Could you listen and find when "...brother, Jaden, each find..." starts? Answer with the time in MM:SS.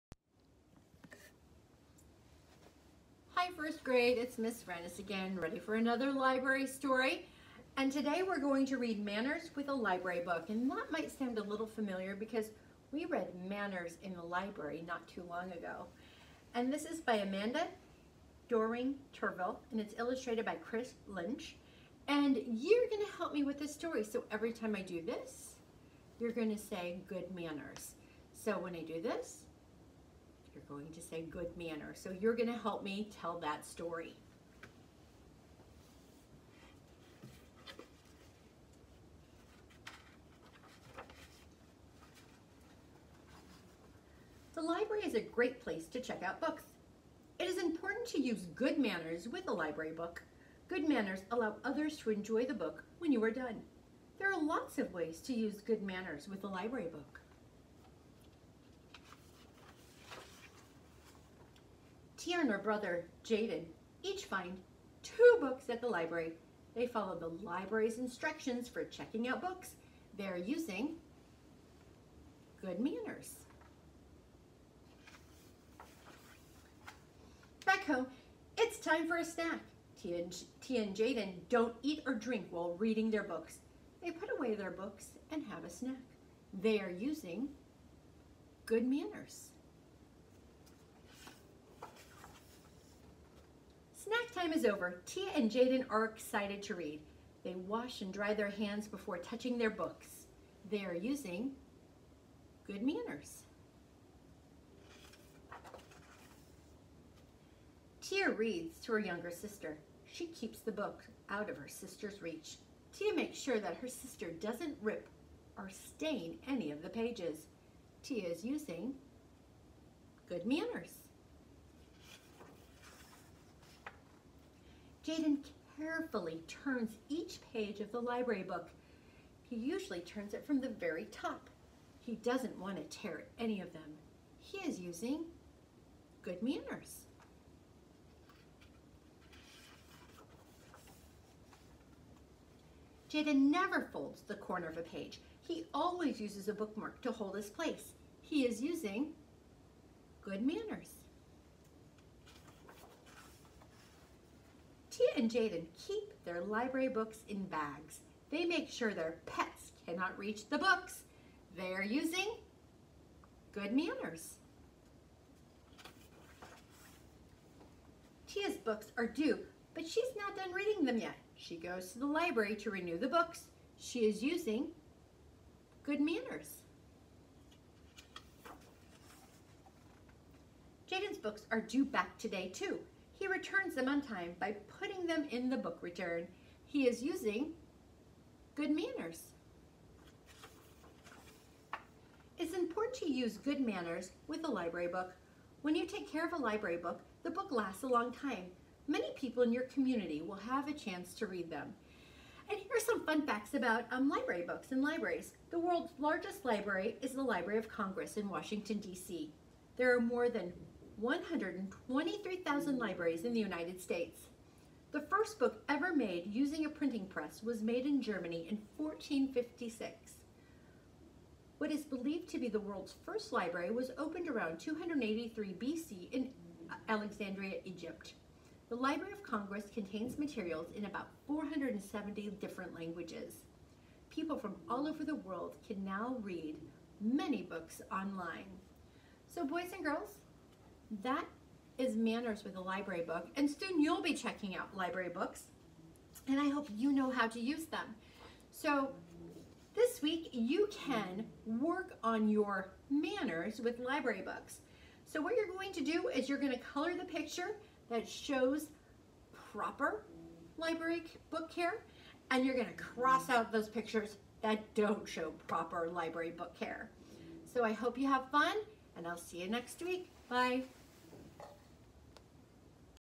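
01:02.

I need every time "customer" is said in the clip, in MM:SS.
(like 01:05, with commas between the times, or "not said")
not said.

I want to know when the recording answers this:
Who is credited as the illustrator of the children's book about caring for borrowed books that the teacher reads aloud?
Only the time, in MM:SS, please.
00:20.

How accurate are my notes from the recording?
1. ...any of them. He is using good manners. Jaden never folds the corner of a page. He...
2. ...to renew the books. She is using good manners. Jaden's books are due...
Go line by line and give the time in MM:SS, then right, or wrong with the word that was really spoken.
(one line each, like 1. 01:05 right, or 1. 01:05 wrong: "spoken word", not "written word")
1. 02:13 right
2. 02:52 right.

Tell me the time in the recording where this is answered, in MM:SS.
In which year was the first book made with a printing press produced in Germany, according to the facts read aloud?
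03:38.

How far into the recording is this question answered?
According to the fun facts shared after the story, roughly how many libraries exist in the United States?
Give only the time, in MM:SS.
03:30.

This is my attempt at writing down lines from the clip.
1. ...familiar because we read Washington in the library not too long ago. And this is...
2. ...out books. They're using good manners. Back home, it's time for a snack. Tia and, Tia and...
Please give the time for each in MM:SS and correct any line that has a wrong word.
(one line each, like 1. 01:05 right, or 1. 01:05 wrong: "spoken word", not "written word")
1. 00:11 wrong: "Manners", not "Washington"
2. 01:09 right.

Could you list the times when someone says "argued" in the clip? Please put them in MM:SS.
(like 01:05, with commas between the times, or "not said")
not said.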